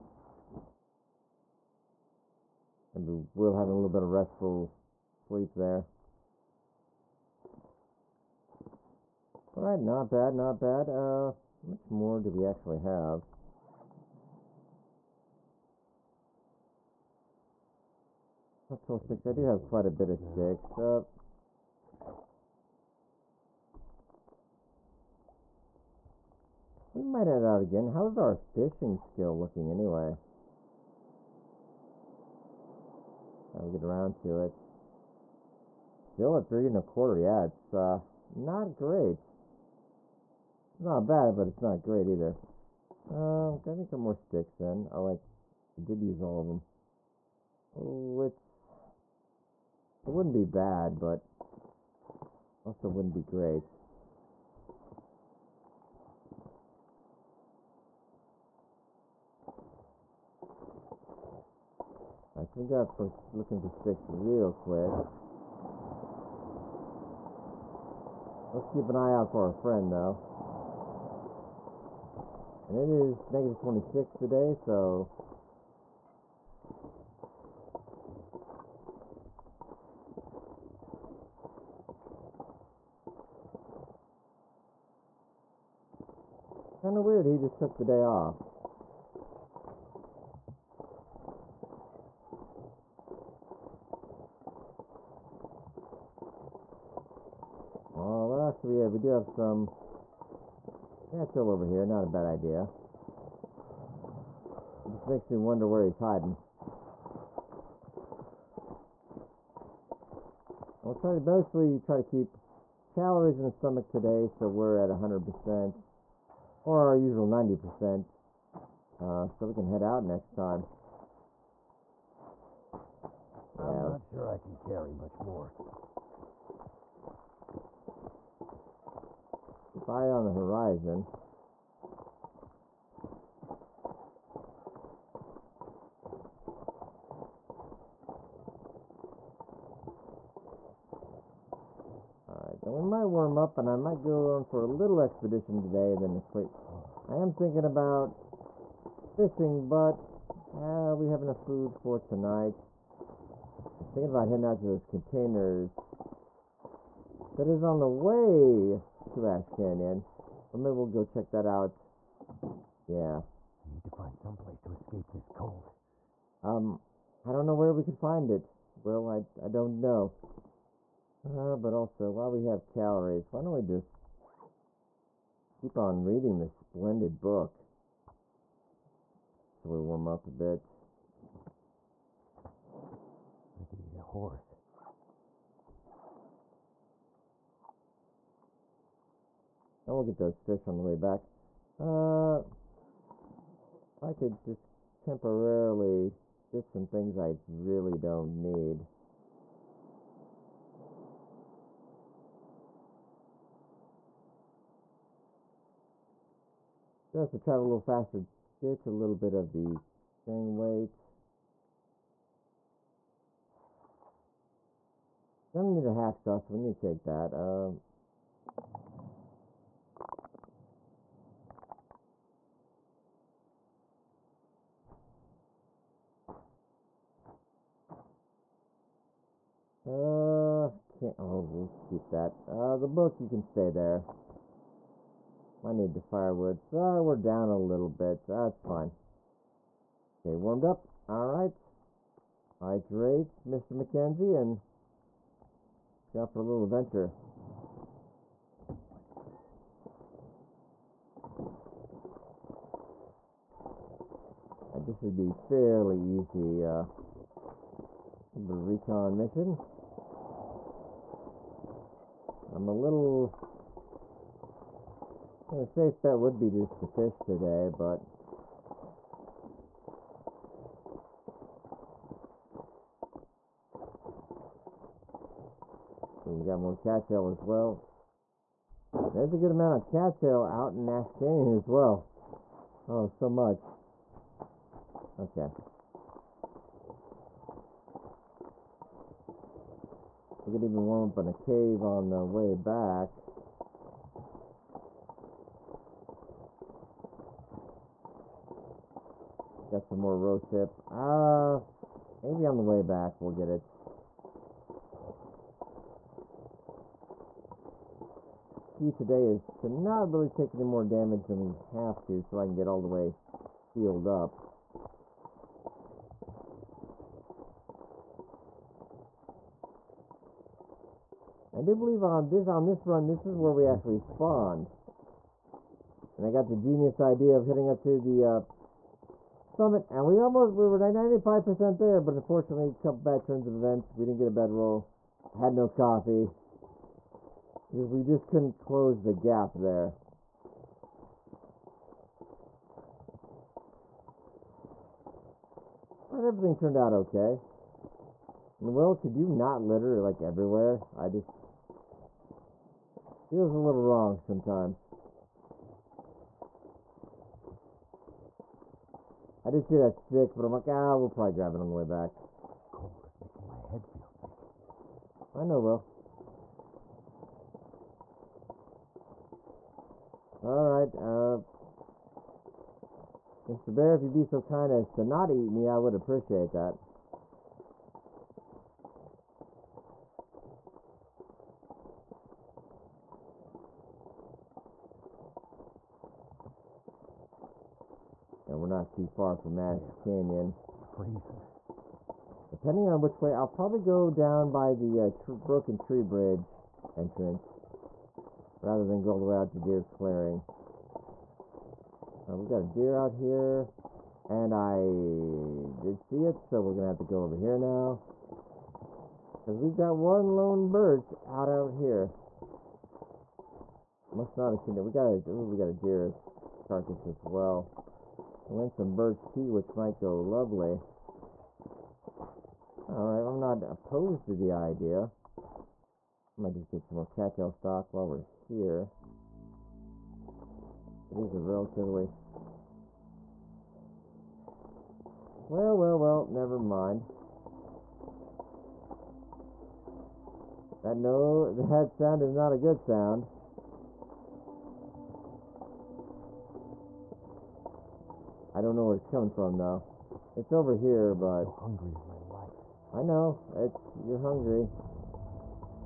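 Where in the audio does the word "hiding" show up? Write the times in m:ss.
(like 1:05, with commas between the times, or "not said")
1:45.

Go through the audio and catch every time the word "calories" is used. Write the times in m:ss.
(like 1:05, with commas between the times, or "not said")
1:52, 2:52.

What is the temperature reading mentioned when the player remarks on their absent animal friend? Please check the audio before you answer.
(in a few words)
-26.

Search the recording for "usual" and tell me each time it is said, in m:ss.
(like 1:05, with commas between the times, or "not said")
1:56.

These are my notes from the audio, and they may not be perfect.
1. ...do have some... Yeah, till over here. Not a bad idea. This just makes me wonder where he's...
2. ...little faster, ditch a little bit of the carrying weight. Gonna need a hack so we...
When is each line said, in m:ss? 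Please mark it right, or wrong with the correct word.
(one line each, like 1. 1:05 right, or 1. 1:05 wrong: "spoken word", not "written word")
1. 1:38 right
2. 3:27 right.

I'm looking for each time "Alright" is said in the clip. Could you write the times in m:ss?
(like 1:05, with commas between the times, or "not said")
0:09, 1:02, 2:22, 4:01, 6:10, 7:02.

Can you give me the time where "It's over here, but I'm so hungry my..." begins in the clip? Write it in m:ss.
7:30.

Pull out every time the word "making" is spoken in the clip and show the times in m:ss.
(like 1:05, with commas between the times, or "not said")
6:03.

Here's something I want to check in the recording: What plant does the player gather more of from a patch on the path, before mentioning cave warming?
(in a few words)
rose hip.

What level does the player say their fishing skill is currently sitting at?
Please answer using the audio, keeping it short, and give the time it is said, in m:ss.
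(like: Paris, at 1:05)
3 and a quarter, at 0:36.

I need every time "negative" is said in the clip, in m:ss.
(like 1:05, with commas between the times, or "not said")
1:13.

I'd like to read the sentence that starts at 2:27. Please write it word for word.
I am thinking about fishing, but uh, we have enough food for tonight.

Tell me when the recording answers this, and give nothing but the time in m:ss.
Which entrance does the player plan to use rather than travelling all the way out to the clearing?
6:35.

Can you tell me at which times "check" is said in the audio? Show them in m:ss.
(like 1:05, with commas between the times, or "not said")
2:41.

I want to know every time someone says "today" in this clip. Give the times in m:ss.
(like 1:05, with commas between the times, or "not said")
1:14, 1:53, 2:25, 4:27, 5:08.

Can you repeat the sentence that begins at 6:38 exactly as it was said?
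Rather than go all the way out to Deer Clearing.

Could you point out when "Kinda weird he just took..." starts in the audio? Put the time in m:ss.
1:26.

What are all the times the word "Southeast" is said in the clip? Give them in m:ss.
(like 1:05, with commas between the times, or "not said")
not said.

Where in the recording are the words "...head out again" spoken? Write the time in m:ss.
0:27.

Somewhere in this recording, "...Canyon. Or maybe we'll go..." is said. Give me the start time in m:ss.
2:39.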